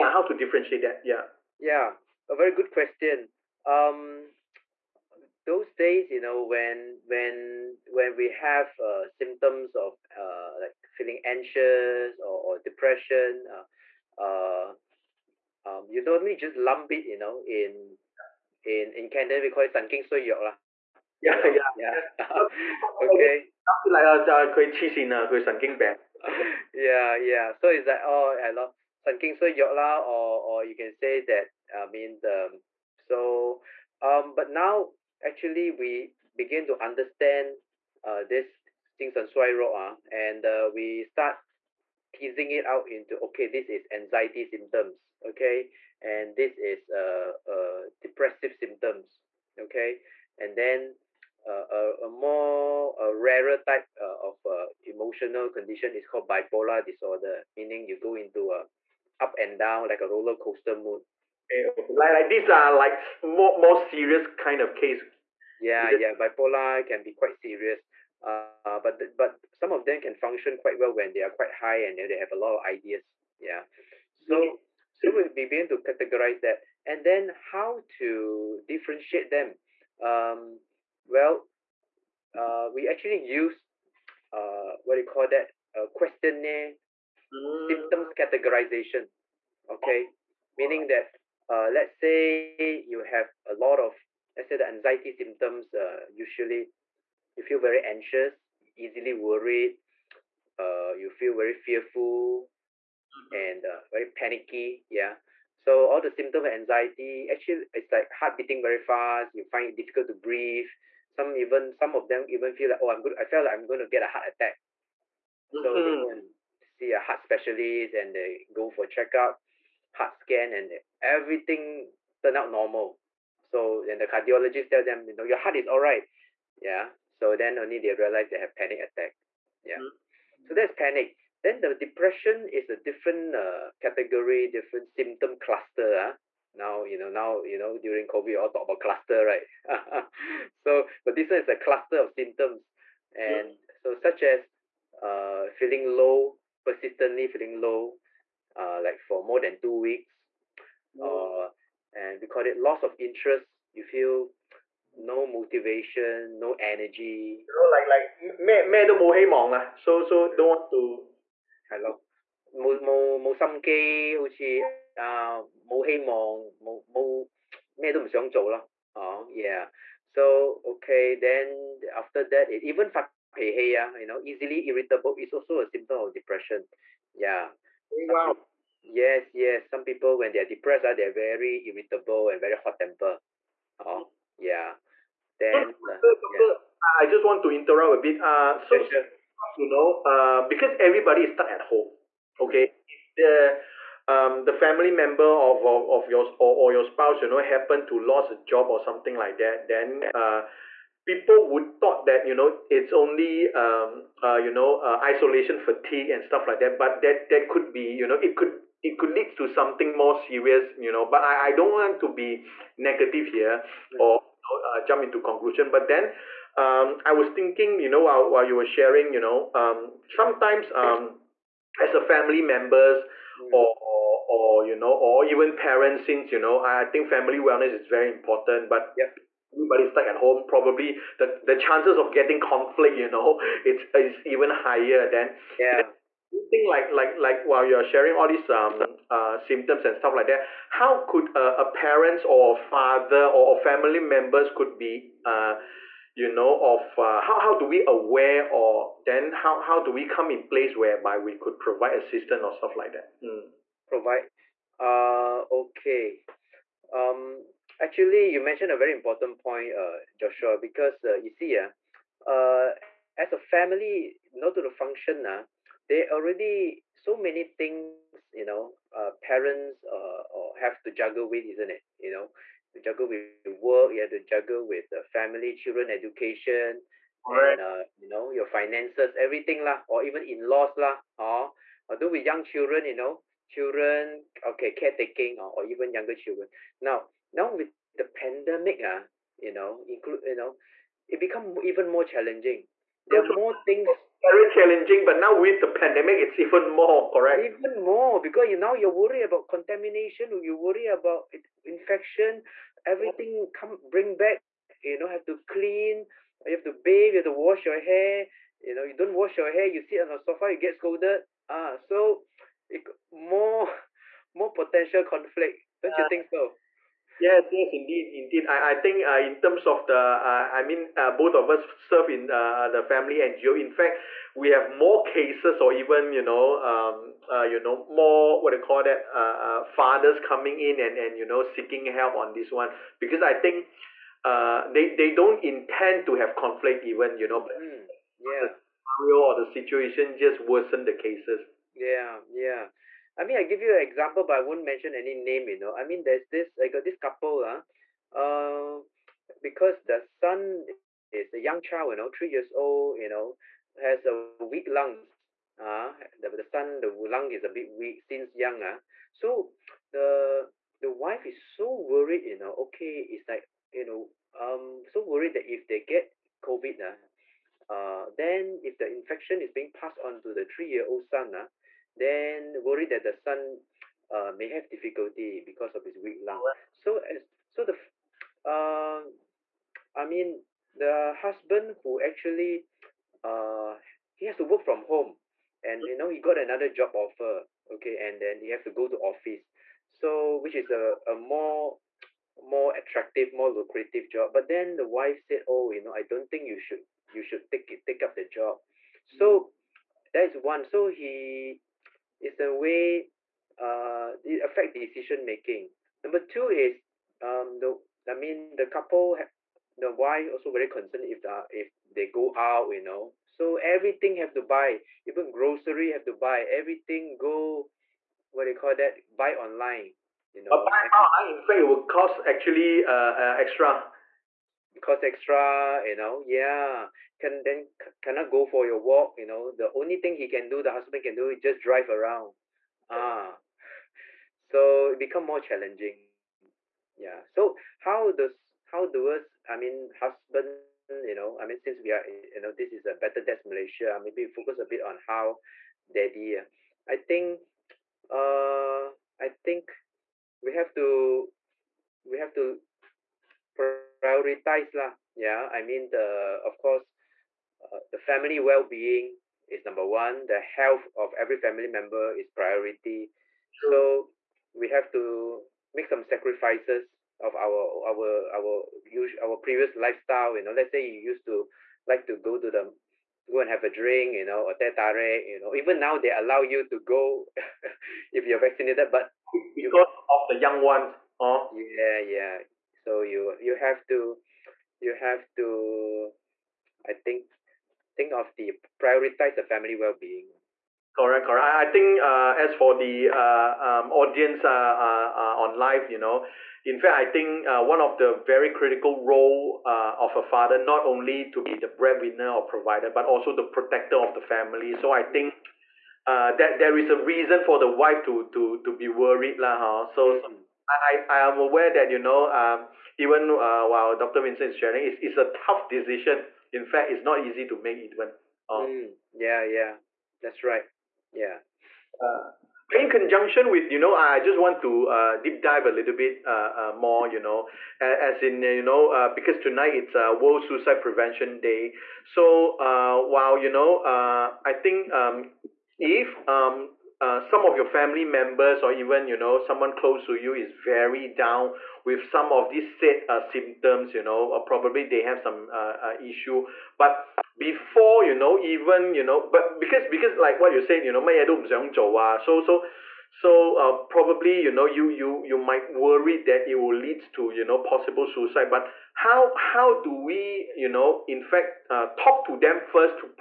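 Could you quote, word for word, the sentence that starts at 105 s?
So all the symptom of anxiety, actually, it's like heart beating very fast.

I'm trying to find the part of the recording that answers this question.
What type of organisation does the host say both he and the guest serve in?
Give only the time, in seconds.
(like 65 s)
322 s.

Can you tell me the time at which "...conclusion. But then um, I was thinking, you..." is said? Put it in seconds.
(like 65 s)
215 s.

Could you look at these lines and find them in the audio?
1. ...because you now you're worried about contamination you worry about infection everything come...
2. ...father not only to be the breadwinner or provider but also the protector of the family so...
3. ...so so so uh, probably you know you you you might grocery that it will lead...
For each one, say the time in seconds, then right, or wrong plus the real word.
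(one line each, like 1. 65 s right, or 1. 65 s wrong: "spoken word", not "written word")
1. 298 s right
2. 500 s right
3. 552 s wrong: "worry", not "grocery".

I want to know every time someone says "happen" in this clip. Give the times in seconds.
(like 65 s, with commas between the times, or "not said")
197 s.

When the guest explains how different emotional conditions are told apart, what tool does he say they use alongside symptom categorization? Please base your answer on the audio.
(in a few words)
Questionnaire.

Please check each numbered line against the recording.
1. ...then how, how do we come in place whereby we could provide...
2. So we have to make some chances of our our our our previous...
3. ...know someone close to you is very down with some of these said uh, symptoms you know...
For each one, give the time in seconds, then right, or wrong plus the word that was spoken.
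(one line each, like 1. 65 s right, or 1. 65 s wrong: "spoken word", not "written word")
1. 249 s right
2. 463 s wrong: "sacrifices", not "chances"
3. 539 s right.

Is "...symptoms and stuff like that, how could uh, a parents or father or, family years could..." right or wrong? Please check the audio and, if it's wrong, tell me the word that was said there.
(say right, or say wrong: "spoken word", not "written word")
wrong: "members", not "years".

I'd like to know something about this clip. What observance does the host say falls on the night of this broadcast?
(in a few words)
World Suicide Prevention Day.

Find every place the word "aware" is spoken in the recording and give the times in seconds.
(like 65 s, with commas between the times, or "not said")
247 s, 511 s.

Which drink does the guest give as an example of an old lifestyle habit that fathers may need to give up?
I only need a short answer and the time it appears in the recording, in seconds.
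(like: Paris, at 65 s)
Teh tarik, at 474 s.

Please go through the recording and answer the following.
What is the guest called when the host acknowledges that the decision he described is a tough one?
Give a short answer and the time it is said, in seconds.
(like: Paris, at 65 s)
Dr. Vincent, at 513 s.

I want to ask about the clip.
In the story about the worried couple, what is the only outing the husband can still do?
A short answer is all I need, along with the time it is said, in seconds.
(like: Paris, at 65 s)
Drive around, at 431 s.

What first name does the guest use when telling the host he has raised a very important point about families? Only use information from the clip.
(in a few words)
Joshua.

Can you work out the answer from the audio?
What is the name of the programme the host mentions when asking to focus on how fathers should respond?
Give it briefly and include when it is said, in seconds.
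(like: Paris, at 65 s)
Better Dads Malaysia, at 442 s.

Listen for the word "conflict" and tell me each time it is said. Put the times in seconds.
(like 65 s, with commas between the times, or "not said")
232 s, 315 s, 336 s.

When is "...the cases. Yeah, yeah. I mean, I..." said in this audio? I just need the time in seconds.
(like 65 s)
340 s.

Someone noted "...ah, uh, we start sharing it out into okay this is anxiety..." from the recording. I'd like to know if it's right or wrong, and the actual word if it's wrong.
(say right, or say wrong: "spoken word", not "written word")
wrong: "teasing", not "sharing".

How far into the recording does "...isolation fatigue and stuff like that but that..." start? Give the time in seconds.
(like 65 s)
205 s.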